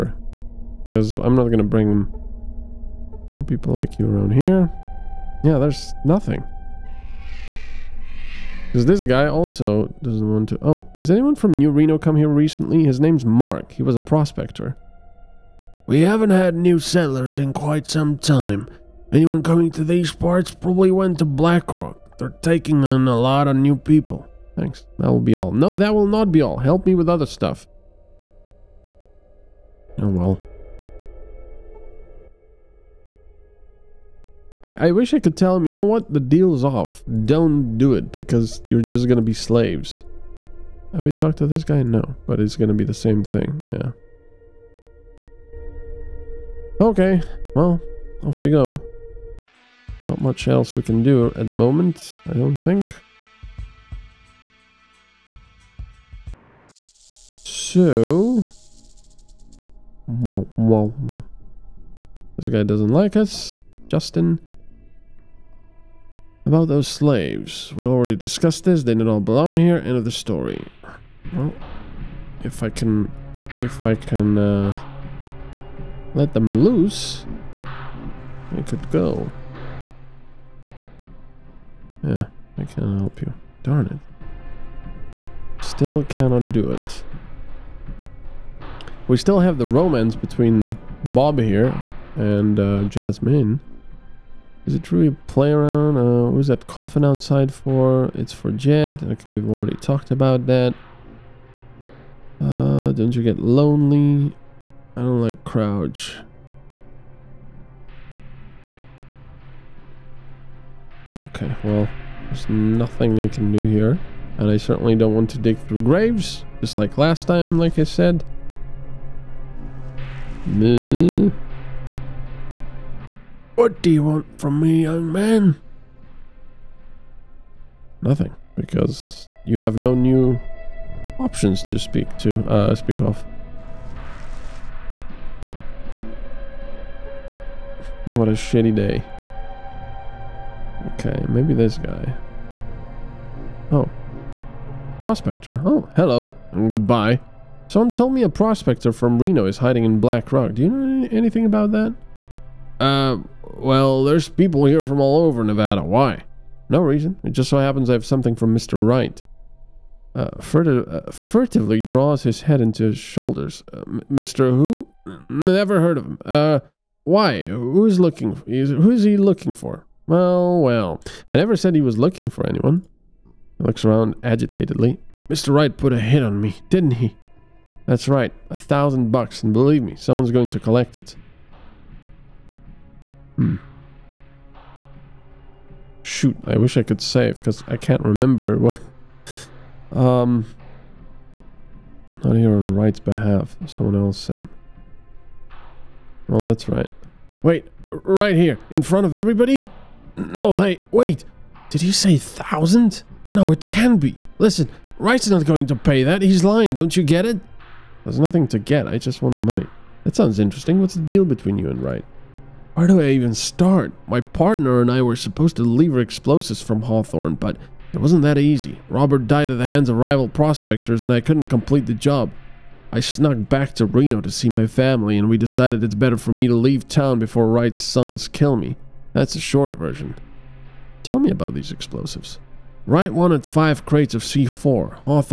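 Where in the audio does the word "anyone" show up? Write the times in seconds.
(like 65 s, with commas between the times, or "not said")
11 s, 19 s, 172 s.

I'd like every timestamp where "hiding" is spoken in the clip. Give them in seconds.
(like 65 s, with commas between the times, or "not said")
149 s.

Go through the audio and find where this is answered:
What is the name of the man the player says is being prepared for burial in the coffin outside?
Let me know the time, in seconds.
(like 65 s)
98 s.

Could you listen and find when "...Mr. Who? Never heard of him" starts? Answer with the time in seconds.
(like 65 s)
164 s.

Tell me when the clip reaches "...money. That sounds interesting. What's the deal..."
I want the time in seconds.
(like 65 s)
209 s.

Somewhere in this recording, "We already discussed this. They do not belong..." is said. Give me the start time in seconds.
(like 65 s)
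67 s.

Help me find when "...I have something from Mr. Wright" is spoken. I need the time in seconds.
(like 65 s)
157 s.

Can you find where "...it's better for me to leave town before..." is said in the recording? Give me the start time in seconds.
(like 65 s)
225 s.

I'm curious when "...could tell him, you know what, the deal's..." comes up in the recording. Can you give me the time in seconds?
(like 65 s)
35 s.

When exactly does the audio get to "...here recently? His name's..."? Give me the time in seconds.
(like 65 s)
12 s.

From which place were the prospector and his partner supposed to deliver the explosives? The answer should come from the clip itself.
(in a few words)
Hawthorne.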